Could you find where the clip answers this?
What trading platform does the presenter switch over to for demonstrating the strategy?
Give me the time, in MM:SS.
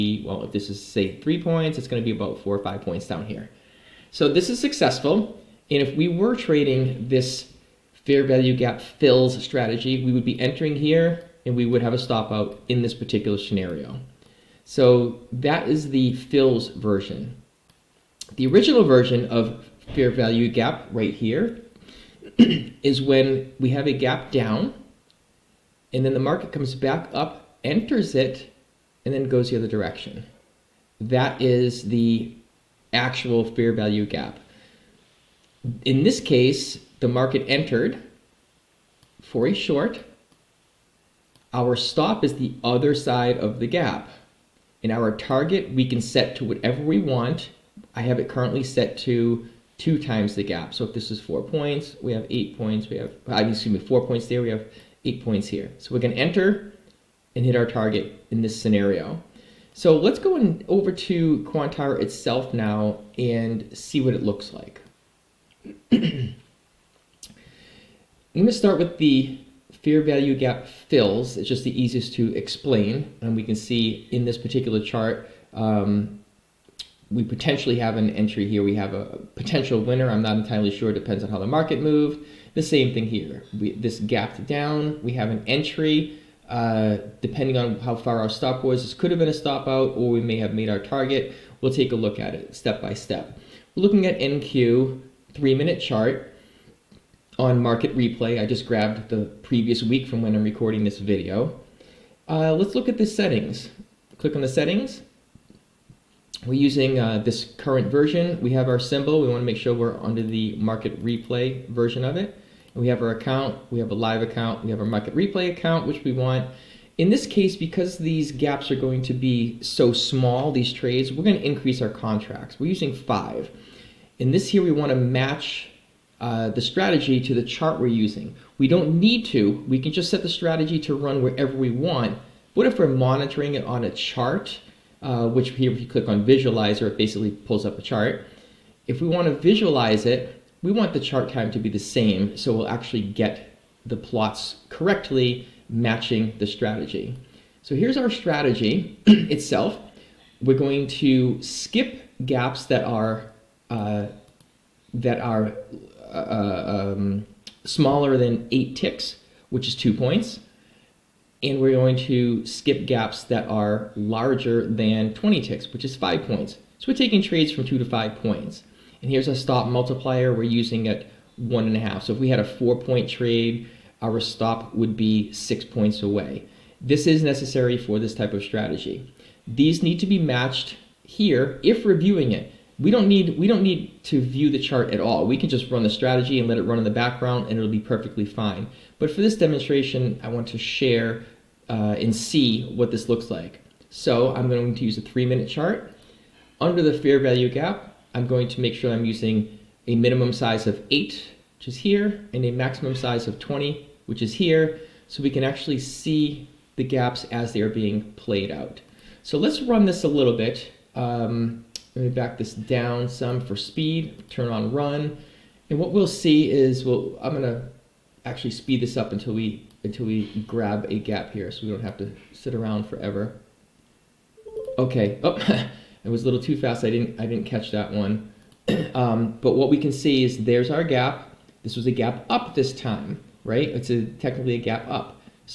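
01:01.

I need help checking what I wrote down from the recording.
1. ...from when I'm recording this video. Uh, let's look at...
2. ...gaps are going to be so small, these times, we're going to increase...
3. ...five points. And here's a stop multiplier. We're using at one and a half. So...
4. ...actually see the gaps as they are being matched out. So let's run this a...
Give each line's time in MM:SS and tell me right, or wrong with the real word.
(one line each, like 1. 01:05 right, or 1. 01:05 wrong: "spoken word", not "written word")
1. 01:40 right
2. 01:58 wrong: "trades", not "times"
3. 02:47 right
4. 03:25 wrong: "played", not "matched".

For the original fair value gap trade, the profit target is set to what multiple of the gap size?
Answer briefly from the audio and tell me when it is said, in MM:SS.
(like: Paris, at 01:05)
2 times, at 00:49.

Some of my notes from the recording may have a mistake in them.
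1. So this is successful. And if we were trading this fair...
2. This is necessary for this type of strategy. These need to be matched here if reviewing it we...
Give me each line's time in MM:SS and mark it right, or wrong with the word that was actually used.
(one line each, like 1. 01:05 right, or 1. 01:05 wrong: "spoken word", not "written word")
1. 00:04 right
2. 02:56 right.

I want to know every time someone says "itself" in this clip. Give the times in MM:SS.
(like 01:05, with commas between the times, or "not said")
01:01, 02:29.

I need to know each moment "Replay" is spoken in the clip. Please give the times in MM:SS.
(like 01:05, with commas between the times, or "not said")
01:37, 01:51, 01:55.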